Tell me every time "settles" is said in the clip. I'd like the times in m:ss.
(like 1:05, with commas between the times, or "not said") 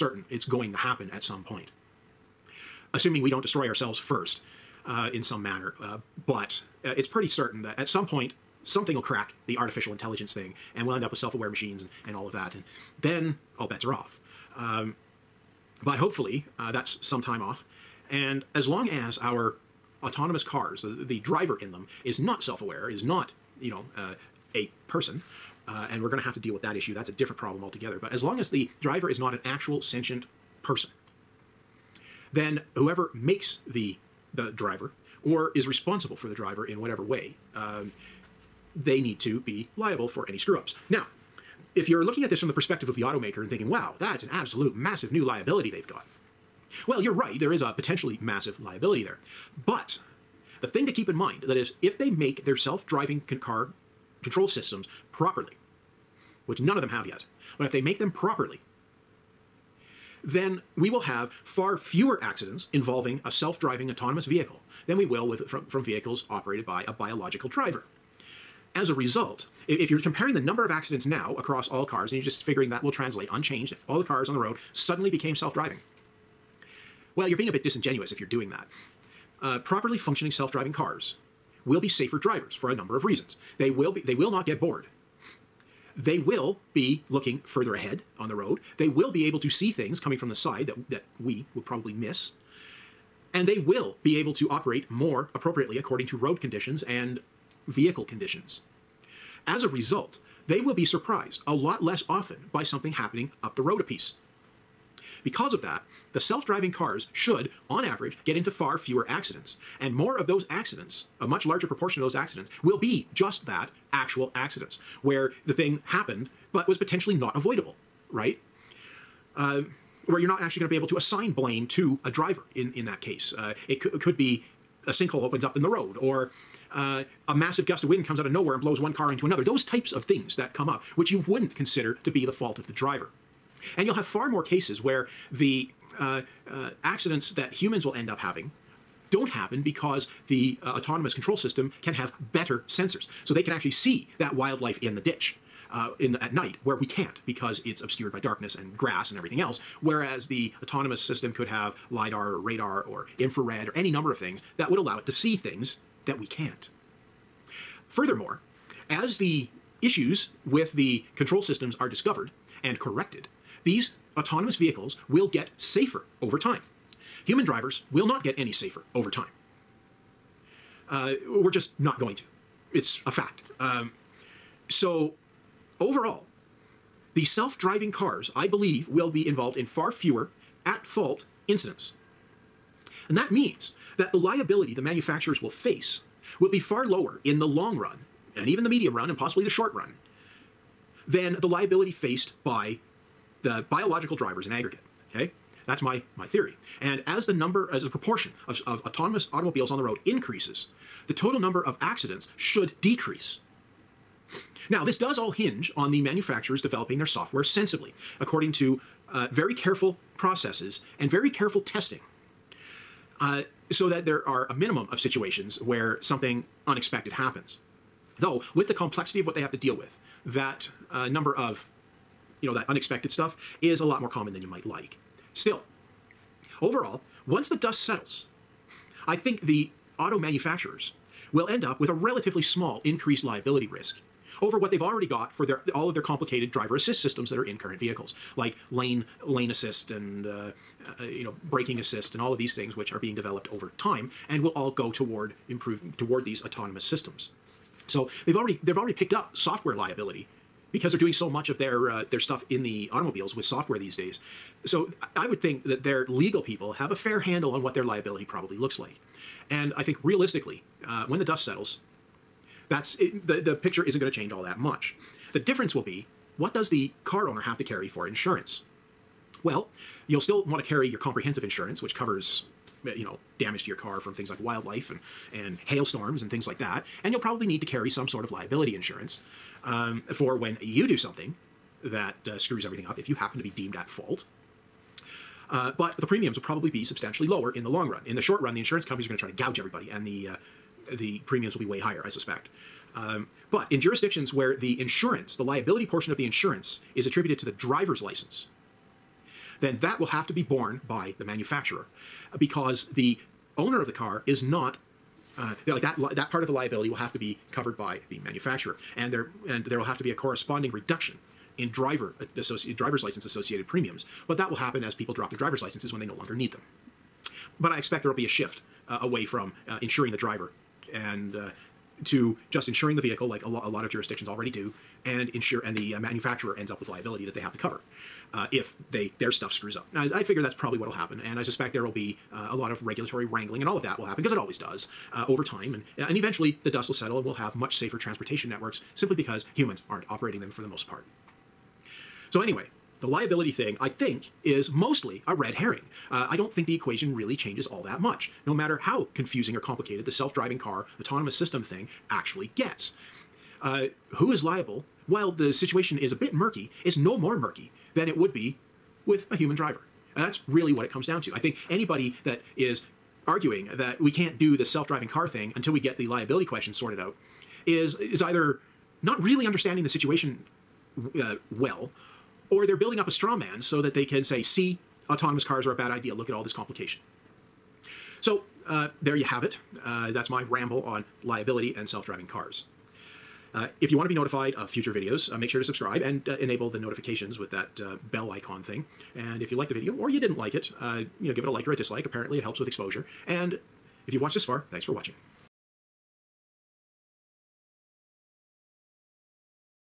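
3:47, 4:21, 5:36.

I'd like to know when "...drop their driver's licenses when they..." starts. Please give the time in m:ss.
5:15.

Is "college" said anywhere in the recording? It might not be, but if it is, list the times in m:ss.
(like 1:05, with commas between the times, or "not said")
not said.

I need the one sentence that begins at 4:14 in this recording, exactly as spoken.
So I would think that their legal people have a fair handle on what their liability probably looks like.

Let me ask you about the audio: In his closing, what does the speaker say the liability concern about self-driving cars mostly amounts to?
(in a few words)
a red herring.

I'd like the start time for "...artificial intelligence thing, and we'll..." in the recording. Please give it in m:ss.
0:09.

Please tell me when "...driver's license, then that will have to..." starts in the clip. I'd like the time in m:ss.
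4:57.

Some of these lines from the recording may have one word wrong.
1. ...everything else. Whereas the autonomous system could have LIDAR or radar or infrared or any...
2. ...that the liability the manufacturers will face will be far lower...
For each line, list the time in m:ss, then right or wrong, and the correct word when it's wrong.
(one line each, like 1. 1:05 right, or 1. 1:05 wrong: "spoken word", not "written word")
1. 2:29 right
2. 3:03 right.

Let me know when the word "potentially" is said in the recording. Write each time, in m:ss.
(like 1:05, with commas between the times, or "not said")
0:47, 1:56.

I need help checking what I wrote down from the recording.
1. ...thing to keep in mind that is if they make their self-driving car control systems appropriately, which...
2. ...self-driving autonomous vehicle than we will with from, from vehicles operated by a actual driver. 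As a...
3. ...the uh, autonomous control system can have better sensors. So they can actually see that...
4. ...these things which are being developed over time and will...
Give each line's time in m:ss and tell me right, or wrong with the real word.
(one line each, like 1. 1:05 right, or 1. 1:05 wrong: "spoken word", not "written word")
1. 0:50 wrong: "properly", not "appropriately"
2. 1:03 wrong: "biological", not "actual"
3. 2:20 right
4. 4:02 right.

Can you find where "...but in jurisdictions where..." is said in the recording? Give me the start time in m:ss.
4:53.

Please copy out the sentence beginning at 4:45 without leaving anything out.
Uh, but the premiums will probably be substantially lower in the long run.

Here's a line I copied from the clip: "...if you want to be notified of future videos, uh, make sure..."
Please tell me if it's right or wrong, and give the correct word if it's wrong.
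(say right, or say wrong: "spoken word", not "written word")
right.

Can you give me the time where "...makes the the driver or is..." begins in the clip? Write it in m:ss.
0:33.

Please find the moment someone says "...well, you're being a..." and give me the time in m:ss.
1:17.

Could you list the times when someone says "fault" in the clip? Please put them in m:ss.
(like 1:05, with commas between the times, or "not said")
2:12, 3:00, 4:43.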